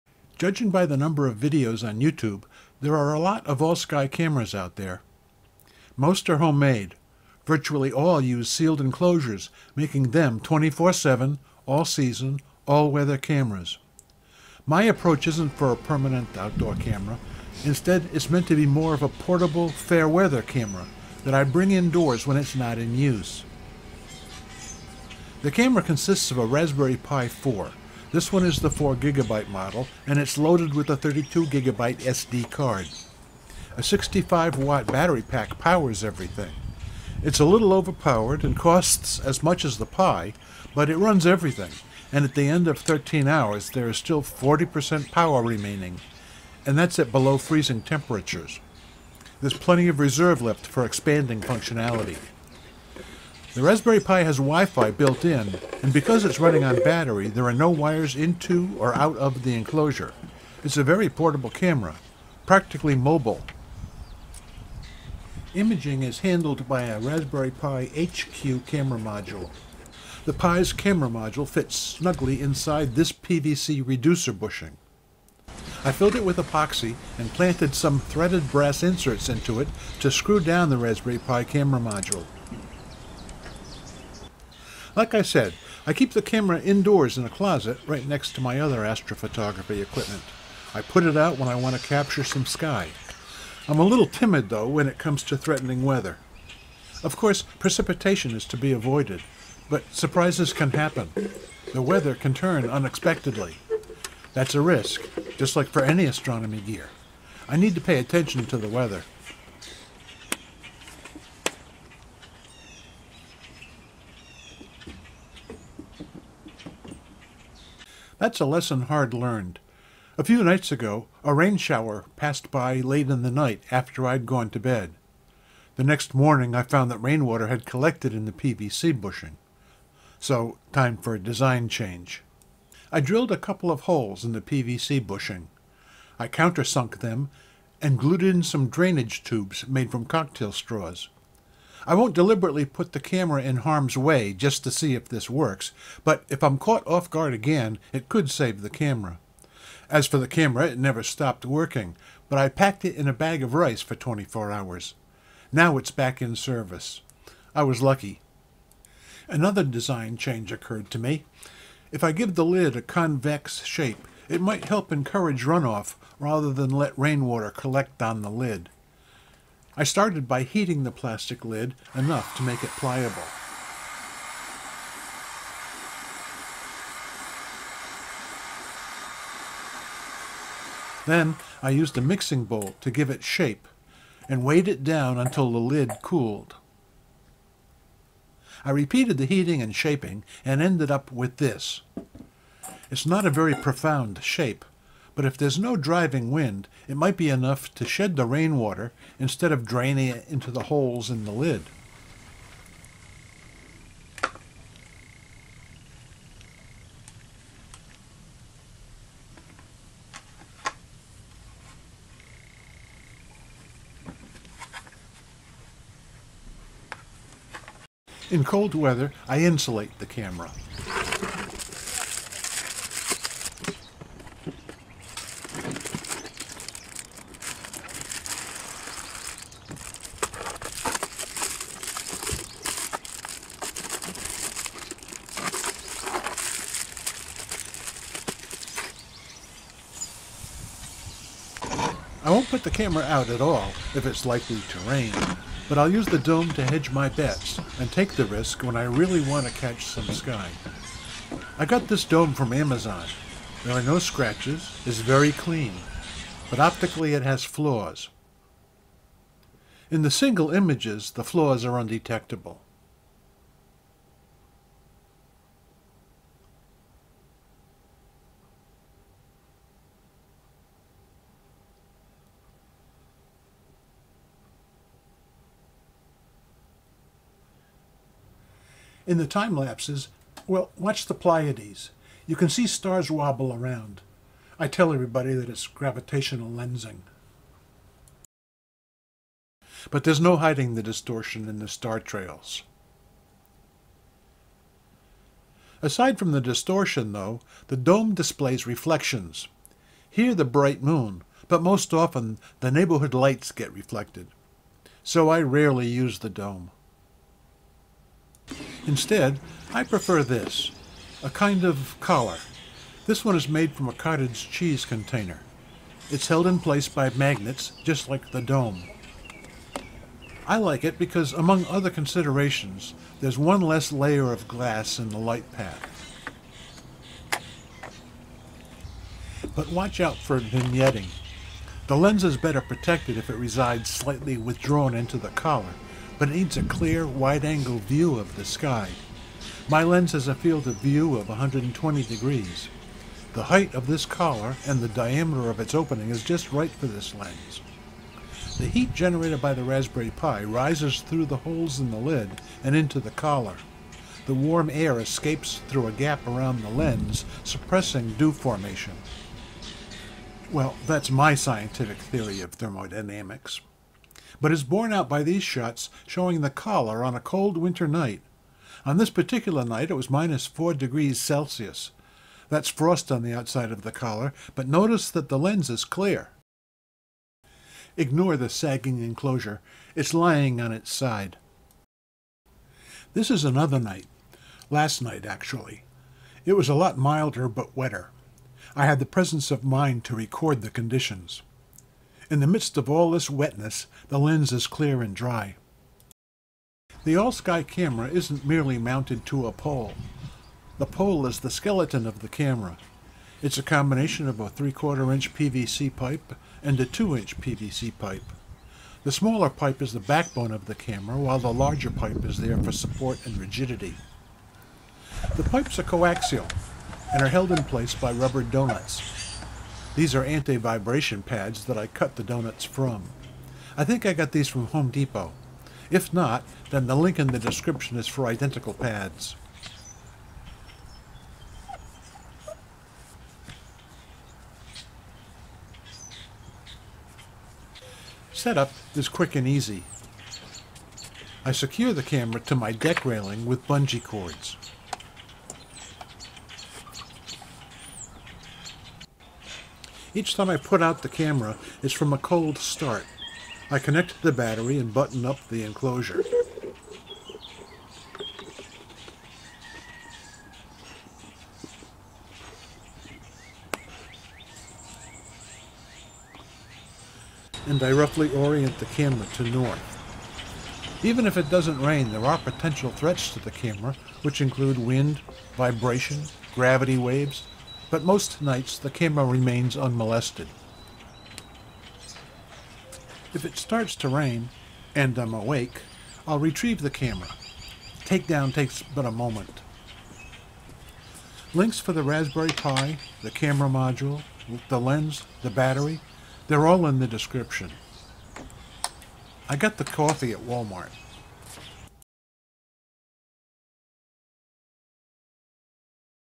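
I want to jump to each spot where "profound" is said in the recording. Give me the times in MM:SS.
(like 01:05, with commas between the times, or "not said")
03:13.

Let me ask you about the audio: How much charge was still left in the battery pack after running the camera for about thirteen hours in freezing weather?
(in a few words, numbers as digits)
40%.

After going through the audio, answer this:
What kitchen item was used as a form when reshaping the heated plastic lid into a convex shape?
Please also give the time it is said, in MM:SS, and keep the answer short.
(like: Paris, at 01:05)
A mixing bowl, at 03:02.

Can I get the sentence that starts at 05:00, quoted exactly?
Here the bright moon, but most often the neighborhood lights get reflected.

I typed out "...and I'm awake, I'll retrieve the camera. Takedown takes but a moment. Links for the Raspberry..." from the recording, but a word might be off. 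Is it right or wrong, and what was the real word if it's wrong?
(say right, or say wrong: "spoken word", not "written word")
right.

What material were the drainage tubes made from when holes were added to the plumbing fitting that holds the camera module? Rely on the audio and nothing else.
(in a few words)
Cocktail straws.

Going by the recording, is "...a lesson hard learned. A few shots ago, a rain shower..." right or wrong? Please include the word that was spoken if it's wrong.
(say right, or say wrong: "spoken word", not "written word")
wrong: "nights", not "shots".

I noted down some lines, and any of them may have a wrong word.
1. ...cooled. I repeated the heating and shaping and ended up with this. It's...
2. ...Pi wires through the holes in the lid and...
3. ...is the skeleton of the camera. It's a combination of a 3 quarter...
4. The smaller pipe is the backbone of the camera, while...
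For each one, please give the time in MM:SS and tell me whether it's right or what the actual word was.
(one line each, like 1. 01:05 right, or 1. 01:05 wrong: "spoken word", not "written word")
1. 03:06 right
2. 05:50 wrong: "rises", not "wires"
3. 06:41 right
4. 06:49 right.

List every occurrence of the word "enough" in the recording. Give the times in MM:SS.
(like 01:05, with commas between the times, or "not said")
02:51, 03:17.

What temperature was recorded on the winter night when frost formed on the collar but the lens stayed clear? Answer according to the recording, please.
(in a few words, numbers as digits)
-4 degrees Celsius.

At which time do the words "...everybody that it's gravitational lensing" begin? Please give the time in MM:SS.
04:44.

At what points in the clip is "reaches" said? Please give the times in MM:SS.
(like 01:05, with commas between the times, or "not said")
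not said.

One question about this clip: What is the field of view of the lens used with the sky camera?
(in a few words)
120 degrees.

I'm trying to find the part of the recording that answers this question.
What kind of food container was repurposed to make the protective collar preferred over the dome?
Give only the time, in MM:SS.
05:13.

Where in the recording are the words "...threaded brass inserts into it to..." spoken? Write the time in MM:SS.
01:17.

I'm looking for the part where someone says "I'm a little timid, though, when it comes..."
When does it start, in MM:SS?
01:33.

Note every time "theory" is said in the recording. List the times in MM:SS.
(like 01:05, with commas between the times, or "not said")
06:01.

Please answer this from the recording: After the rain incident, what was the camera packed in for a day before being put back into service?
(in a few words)
Bag of rice.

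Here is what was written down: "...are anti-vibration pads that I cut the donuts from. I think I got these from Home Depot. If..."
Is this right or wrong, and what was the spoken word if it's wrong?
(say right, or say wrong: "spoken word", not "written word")
right.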